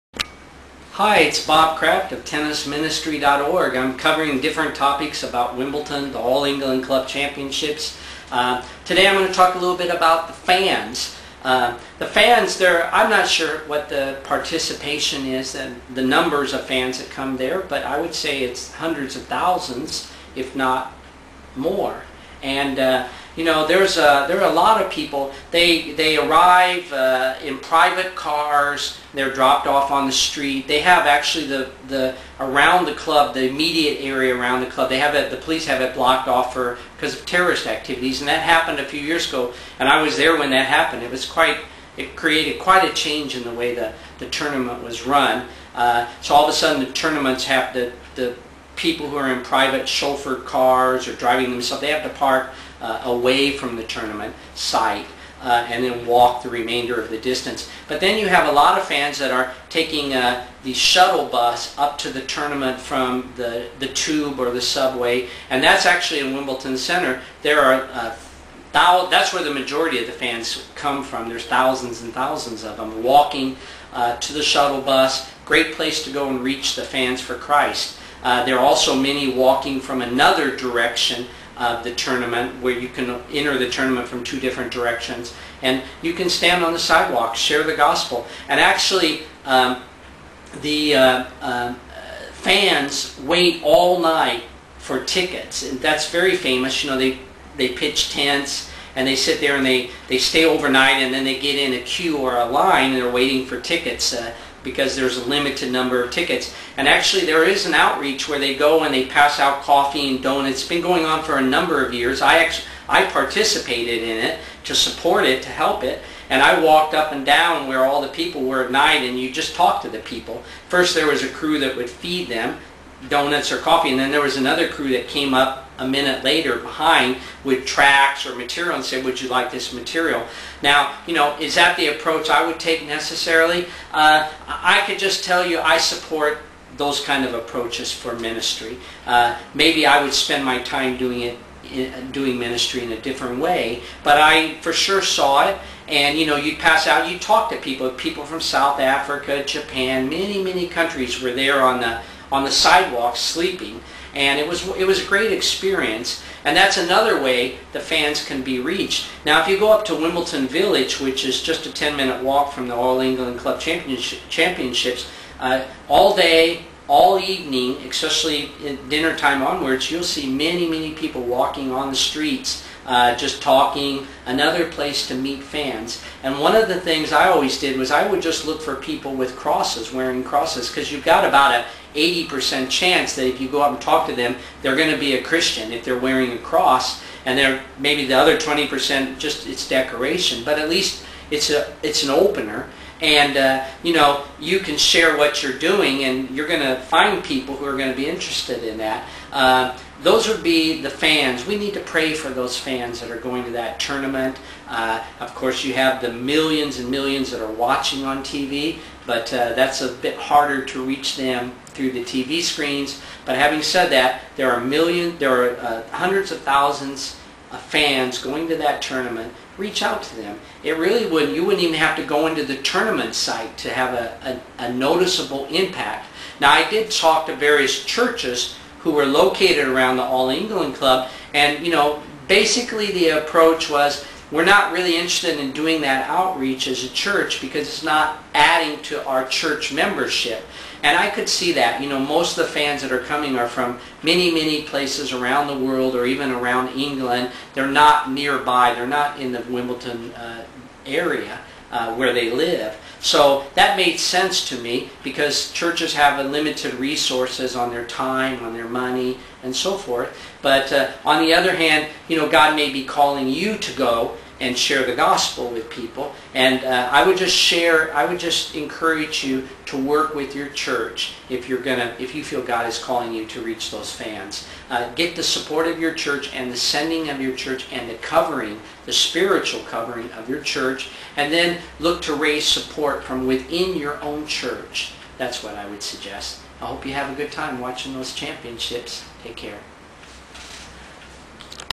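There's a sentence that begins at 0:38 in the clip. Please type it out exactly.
And that happened a few years ago, and I was there when that happened.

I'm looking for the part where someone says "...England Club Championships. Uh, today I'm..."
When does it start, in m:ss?
0:06.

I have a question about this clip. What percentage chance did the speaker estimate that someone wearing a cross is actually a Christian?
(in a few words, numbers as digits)
80%.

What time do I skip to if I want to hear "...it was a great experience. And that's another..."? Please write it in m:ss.
2:34.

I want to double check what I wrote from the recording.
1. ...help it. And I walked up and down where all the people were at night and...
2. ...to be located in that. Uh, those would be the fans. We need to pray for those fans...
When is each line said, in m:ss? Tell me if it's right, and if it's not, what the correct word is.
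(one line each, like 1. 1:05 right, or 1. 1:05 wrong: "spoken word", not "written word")
1. 1:55 right
2. 3:17 wrong: "interested", not "located".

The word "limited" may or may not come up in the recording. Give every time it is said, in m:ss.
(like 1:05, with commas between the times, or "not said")
1:45, 4:16.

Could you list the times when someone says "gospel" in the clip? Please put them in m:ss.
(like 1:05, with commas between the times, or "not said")
1:27, 4:24.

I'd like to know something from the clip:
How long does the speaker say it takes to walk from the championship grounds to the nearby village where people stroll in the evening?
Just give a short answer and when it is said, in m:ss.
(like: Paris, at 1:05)
10 minutes, at 2:41.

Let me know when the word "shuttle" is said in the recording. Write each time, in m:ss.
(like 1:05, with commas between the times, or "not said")
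1:00, 1:14.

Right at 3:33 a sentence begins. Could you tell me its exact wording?
But having said that, there are million, there are uh, hundreds of thousands of fans going to that tournament.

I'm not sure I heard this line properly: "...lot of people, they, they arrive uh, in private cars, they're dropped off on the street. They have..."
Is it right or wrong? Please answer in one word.
right.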